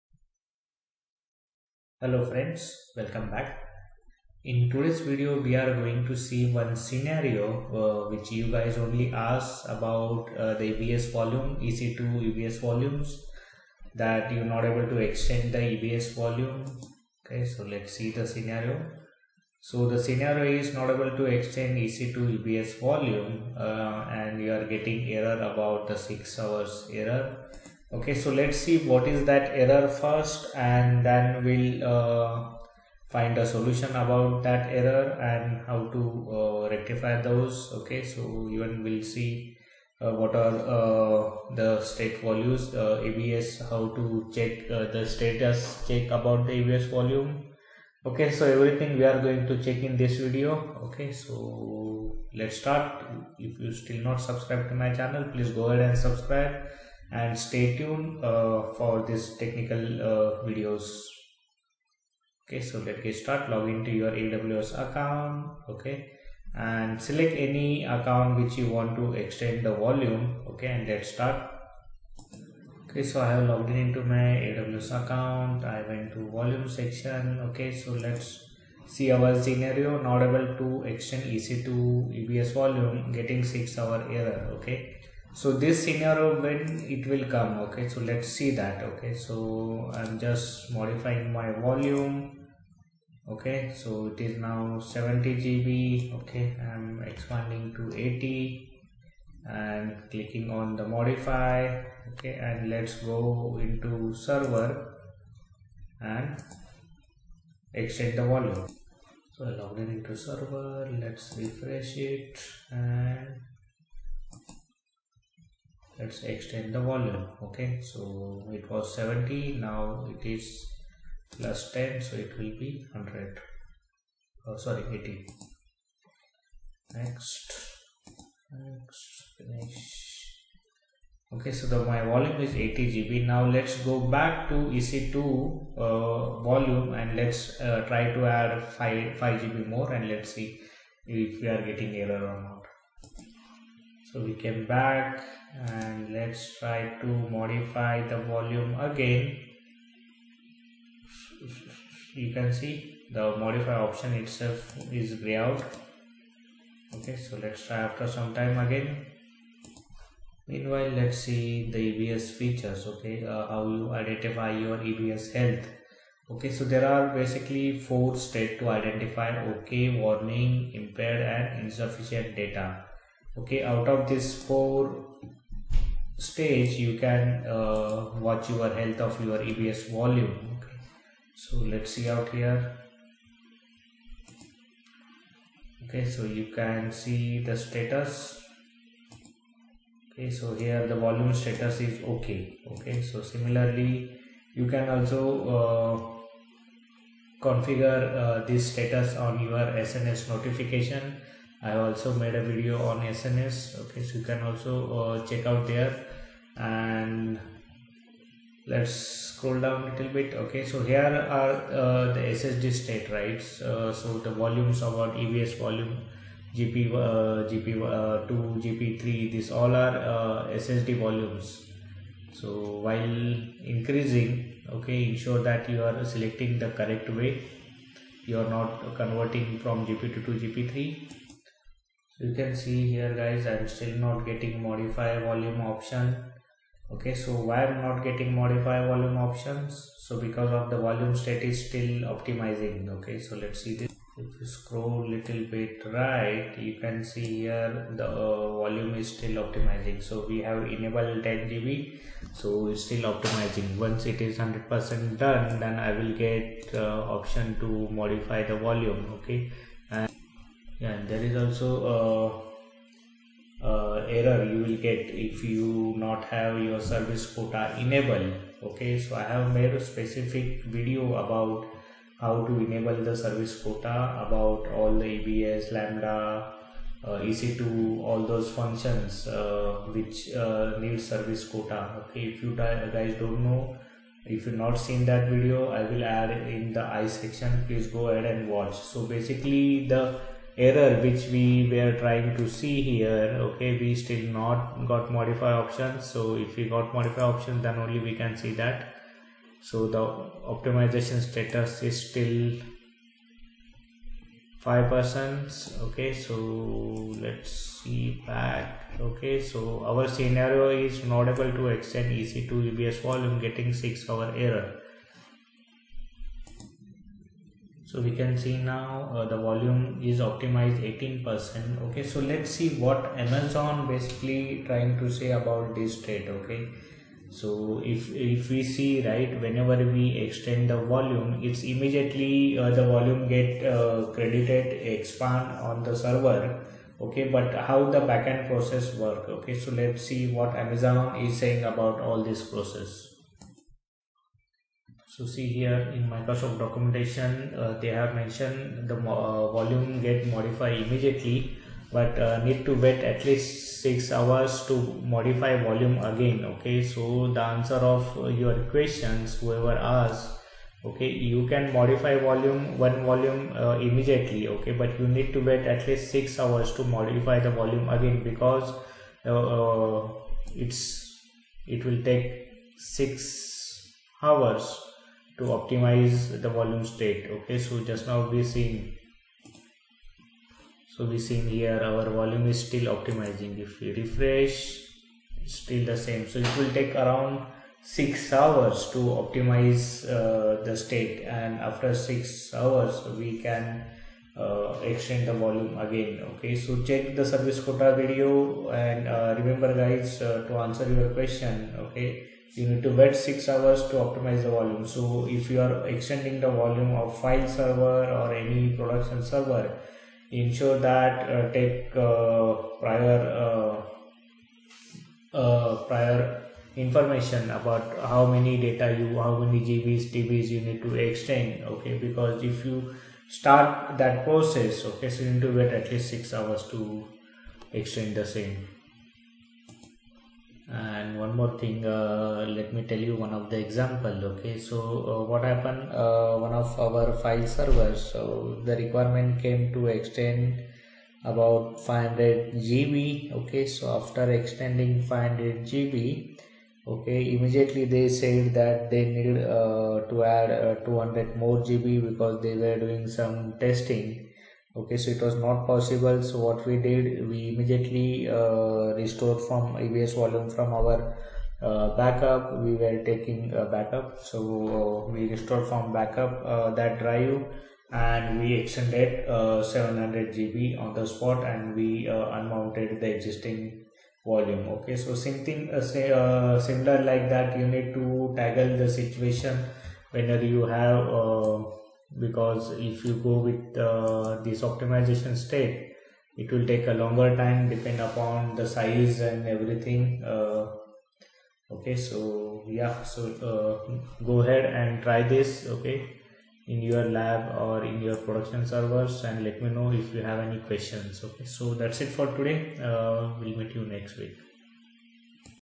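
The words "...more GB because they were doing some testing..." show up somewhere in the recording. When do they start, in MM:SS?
07:31.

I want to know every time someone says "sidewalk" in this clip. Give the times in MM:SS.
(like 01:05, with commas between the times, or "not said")
not said.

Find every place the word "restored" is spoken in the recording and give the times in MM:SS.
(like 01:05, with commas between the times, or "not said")
07:38, 07:45.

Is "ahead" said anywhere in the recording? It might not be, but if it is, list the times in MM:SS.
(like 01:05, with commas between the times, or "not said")
00:55, 04:48, 08:14.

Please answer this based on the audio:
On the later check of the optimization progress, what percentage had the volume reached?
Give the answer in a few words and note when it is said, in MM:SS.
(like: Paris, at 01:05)
18%, at 05:20.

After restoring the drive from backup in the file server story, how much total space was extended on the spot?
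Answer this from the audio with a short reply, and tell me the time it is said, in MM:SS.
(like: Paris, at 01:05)
700 GB, at 07:49.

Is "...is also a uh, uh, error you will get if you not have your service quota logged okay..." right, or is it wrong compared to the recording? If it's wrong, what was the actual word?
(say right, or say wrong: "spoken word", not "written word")
wrong: "enabled", not "logged".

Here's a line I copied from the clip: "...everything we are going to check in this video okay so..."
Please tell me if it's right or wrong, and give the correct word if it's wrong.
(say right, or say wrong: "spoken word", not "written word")
right.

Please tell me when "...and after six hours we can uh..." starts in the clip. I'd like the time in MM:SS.
06:31.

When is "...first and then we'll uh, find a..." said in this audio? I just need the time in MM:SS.
00:29.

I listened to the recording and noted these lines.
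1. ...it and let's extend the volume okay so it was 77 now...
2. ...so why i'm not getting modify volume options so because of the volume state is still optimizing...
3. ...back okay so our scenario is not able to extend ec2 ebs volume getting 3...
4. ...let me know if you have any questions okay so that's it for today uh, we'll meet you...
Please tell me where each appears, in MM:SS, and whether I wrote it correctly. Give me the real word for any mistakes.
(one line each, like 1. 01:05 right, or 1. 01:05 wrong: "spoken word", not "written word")
1. 01:51 wrong: "70", not "77"
2. 03:57 right
3. 05:08 wrong: "6", not "3"
4. 08:19 right.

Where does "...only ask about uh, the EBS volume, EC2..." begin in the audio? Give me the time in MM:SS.
00:08.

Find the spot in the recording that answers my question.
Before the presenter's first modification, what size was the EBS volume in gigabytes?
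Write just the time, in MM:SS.
01:34.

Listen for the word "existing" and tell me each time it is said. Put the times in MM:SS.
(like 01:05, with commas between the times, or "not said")
07:53.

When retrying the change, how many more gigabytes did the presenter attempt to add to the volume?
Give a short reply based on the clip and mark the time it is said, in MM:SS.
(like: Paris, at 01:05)
5 GB, at 02:18.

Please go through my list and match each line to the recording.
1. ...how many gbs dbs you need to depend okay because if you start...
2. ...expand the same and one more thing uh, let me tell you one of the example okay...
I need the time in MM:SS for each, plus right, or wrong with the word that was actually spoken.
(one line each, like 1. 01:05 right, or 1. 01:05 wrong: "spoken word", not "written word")
1. 06:59 wrong: "extend", not "depend"
2. 07:07 wrong: "extend", not "expand".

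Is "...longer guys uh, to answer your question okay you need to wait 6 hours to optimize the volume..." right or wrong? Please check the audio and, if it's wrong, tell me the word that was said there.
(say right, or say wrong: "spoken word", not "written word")
wrong: "remember", not "longer".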